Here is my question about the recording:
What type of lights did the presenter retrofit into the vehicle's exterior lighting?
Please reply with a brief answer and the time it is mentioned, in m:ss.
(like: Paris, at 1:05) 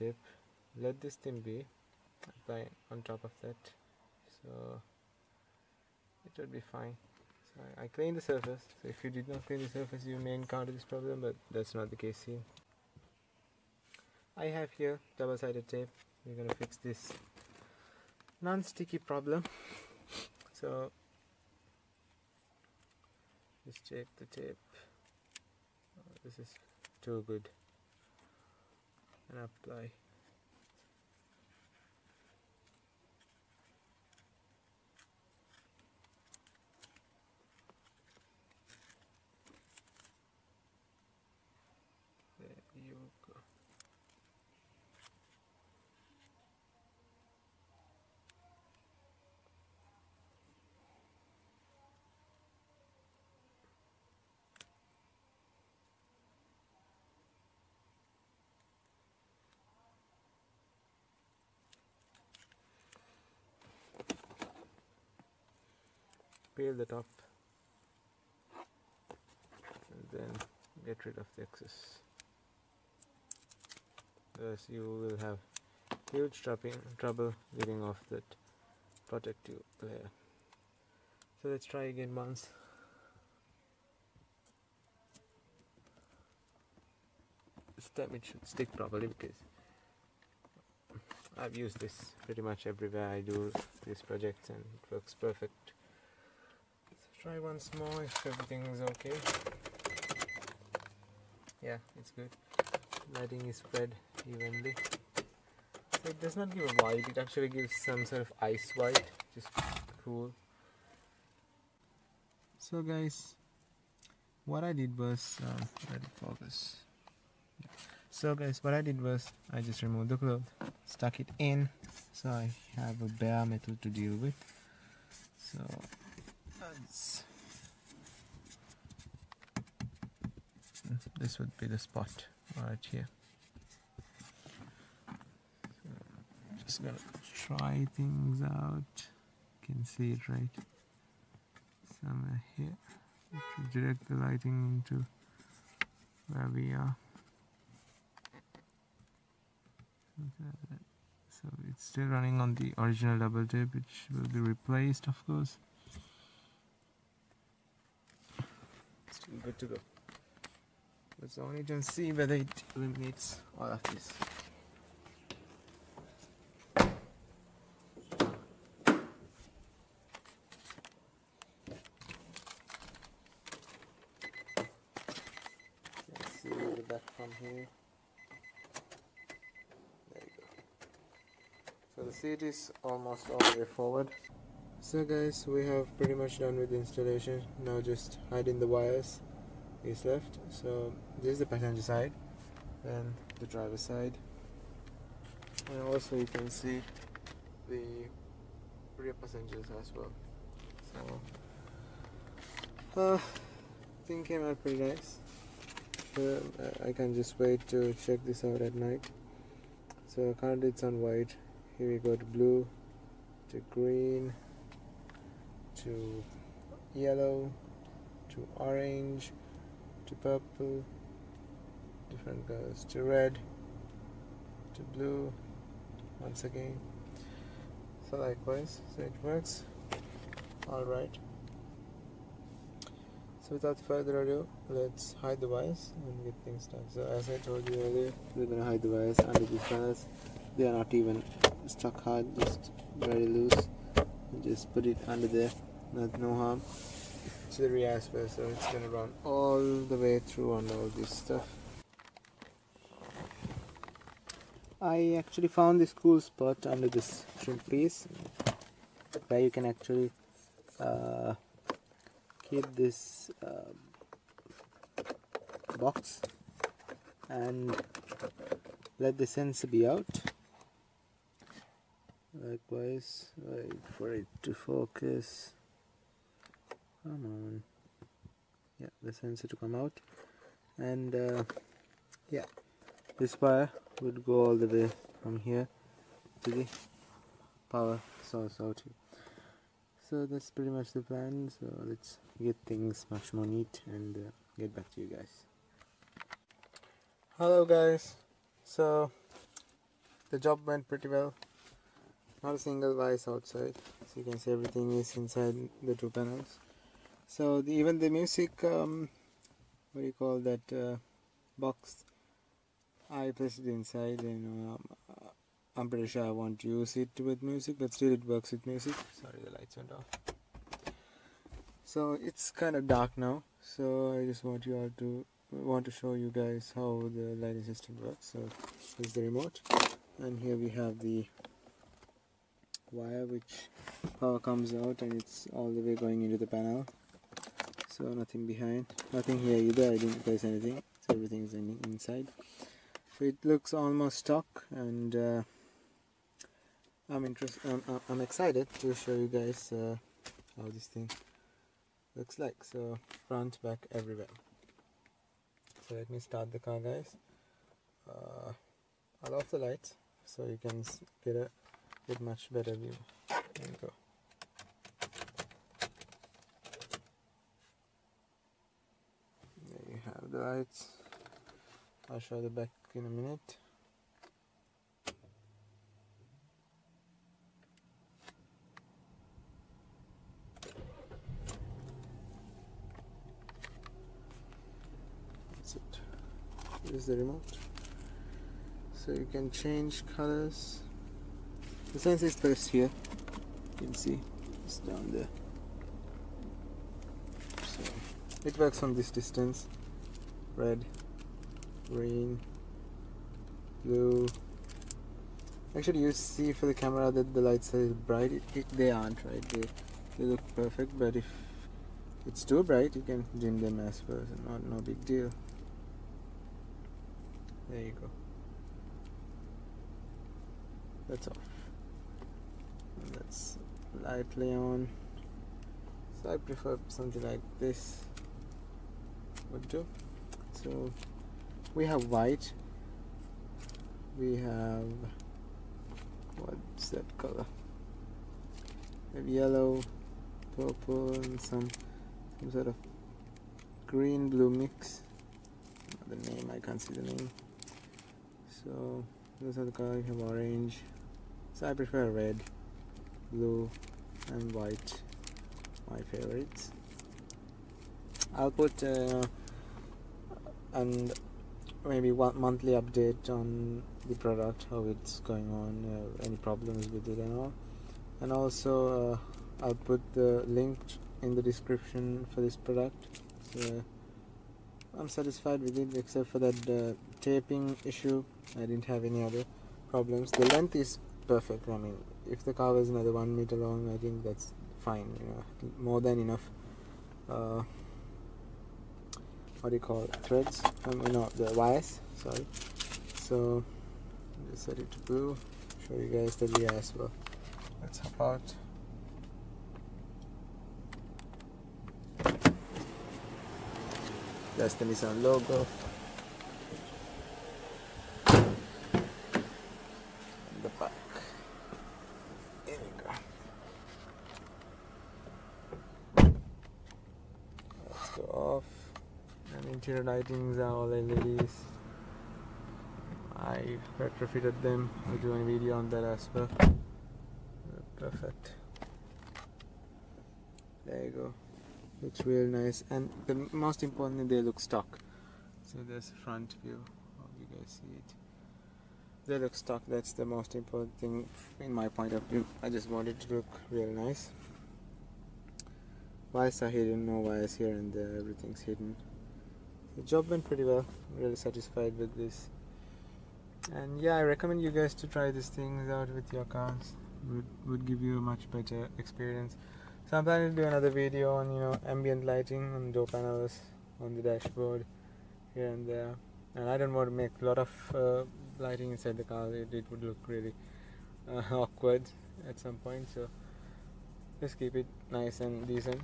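LEDs, at 8:40.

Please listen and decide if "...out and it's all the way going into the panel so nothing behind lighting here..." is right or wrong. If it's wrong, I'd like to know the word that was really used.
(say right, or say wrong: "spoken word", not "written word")
wrong: "nothing", not "lighting".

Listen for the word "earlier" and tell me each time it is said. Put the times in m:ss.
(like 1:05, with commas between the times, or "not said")
3:57.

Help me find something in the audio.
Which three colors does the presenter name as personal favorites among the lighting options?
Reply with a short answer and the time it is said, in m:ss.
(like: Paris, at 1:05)
Red, blue and white, at 7:32.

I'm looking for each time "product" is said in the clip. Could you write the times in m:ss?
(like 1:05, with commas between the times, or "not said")
7:44, 7:52.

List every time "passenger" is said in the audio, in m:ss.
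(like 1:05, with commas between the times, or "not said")
3:11, 3:19.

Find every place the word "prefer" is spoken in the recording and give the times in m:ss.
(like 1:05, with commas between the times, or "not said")
7:06, 7:31.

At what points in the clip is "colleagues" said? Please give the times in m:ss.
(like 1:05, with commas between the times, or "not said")
not said.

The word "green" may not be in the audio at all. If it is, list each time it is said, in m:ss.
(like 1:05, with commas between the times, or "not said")
3:33, 6:41, 7:23.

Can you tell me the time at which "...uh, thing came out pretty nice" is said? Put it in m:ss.
3:23.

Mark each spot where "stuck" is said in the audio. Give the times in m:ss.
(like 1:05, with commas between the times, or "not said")
2:00, 4:01.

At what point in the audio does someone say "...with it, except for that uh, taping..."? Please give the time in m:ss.
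7:55.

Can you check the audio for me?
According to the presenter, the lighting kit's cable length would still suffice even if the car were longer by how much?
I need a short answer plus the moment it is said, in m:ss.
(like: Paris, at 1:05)
1 meter, at 8:02.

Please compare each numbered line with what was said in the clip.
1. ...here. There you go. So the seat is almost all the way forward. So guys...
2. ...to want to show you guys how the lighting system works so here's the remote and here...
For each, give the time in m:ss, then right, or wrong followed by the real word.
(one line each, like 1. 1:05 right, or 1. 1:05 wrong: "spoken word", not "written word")
1. 2:57 right
2. 5:24 right.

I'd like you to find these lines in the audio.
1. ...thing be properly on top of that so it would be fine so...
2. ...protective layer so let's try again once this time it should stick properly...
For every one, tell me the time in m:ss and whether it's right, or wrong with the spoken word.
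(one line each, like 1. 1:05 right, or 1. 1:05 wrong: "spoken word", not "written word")
1. 0:01 wrong: "apply", not "properly"
2. 1:19 right.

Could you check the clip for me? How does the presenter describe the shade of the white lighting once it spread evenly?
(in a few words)
Ice white.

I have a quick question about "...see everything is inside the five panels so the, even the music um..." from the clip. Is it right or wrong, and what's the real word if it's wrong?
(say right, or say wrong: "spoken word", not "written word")
wrong: "two", not "five".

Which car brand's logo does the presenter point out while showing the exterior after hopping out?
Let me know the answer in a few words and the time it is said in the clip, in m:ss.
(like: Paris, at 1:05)
Nissan, at 8:24.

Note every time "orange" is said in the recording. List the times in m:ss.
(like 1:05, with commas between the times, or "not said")
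3:38, 7:30.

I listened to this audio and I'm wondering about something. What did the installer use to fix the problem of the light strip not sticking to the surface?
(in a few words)
Double-sided tape.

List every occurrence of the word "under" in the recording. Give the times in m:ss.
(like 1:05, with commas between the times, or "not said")
3:59, 4:05, 4:16.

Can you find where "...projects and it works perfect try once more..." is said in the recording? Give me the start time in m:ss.
1:34.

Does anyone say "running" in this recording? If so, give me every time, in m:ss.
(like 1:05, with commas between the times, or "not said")
2:32.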